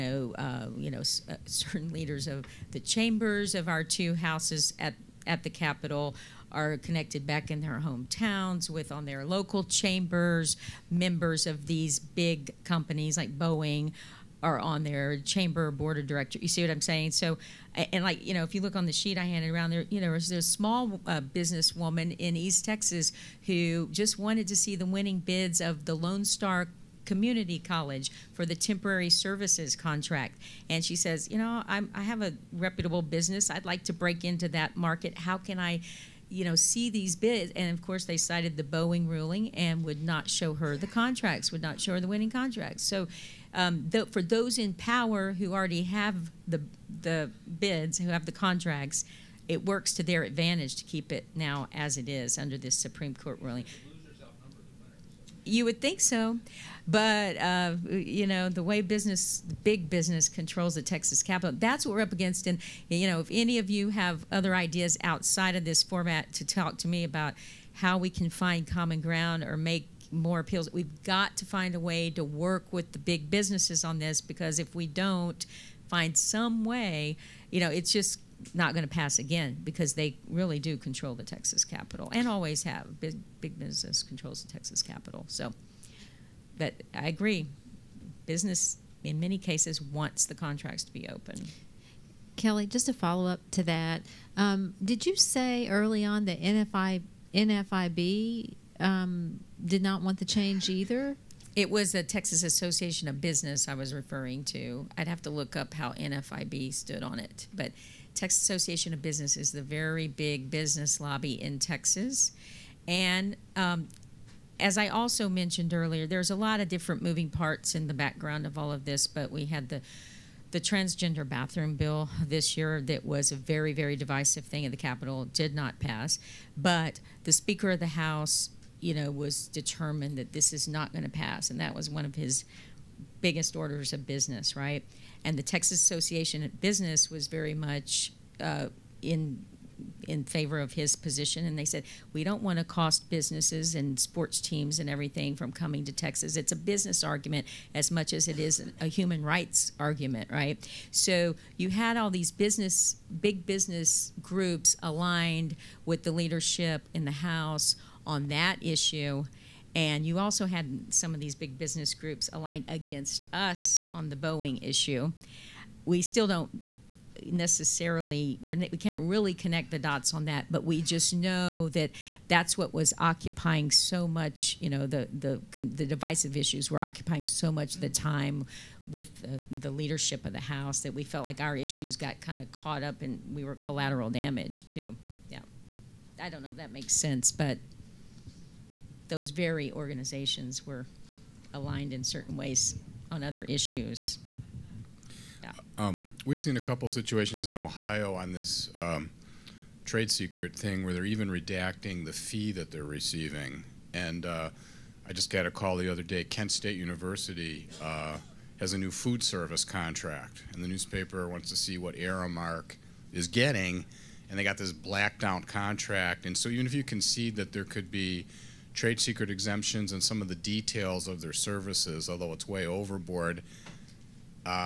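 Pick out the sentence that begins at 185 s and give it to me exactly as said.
Yeah, I don't know if that makes sense, but those very organizations were aligned in certain ways on other issues.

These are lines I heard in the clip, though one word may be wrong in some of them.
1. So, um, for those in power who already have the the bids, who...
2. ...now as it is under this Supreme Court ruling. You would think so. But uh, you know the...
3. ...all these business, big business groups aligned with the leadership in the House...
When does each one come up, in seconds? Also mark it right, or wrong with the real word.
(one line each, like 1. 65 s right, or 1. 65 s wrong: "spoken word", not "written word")
1. 42 s right
2. 51 s right
3. 151 s right.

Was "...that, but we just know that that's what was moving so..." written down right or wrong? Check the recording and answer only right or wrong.
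wrong.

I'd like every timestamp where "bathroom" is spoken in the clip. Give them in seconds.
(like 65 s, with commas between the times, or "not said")
121 s.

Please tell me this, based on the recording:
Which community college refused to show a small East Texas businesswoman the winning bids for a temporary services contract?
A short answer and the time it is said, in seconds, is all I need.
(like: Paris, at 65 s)
Lone Star Community College, at 25 s.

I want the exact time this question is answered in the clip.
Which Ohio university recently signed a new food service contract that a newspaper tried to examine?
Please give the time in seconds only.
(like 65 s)
206 s.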